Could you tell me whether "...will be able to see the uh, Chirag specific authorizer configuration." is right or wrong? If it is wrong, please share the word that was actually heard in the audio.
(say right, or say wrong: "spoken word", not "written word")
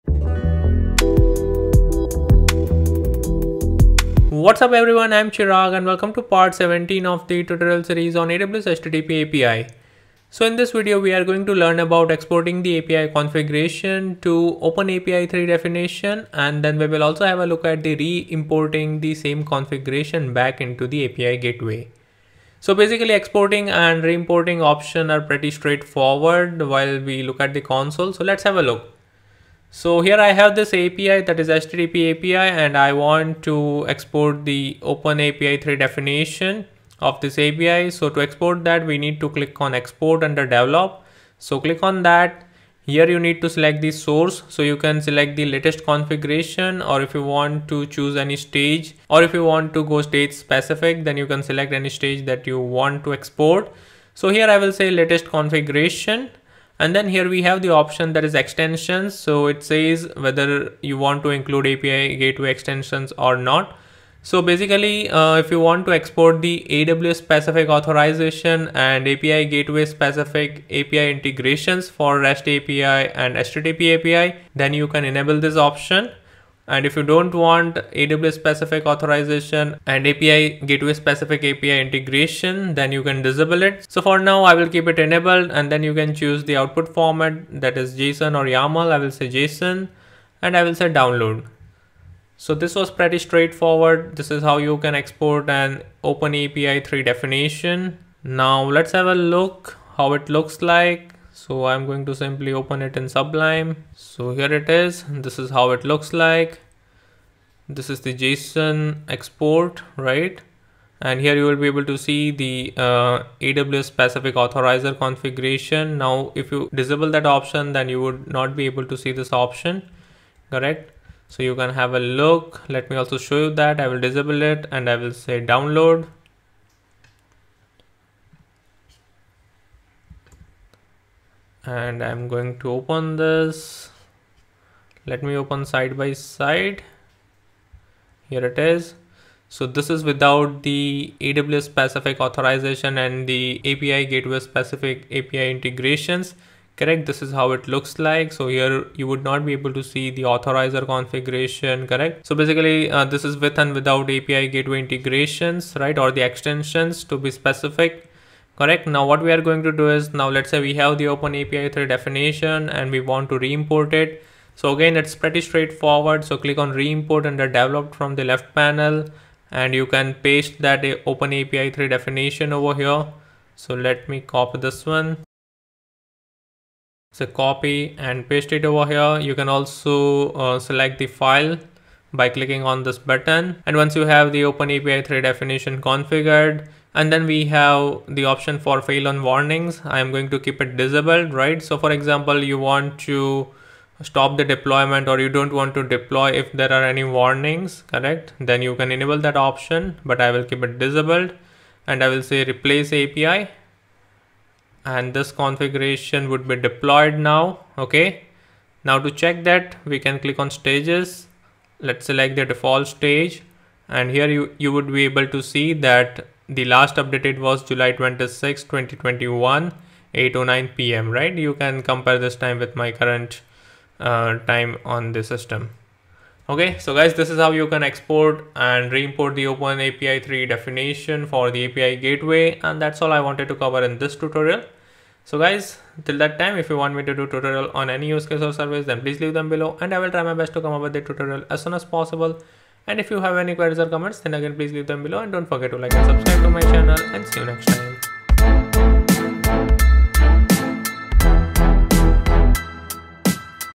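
wrong: "AWS", not "Chirag".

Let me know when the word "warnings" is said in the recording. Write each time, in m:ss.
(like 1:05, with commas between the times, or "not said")
3:09, 3:17.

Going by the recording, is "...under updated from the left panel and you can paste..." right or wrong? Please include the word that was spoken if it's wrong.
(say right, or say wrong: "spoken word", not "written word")
wrong: "developed", not "updated".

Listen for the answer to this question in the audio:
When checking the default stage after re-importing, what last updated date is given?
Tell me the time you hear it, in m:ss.
3:37.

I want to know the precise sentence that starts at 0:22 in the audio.
So basically exporting and re-importing option are pretty straightforward while we look at the console.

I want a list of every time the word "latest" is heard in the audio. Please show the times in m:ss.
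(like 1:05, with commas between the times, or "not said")
0:45, 0:54.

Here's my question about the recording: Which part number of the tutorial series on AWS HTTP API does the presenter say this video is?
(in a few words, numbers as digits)
17.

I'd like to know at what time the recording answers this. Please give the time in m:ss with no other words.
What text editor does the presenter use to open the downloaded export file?
1:43.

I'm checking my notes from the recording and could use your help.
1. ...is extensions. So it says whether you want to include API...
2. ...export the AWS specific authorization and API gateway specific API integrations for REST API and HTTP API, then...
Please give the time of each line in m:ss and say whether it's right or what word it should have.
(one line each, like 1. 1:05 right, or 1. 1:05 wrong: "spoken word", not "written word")
1. 0:58 right
2. 1:05 right.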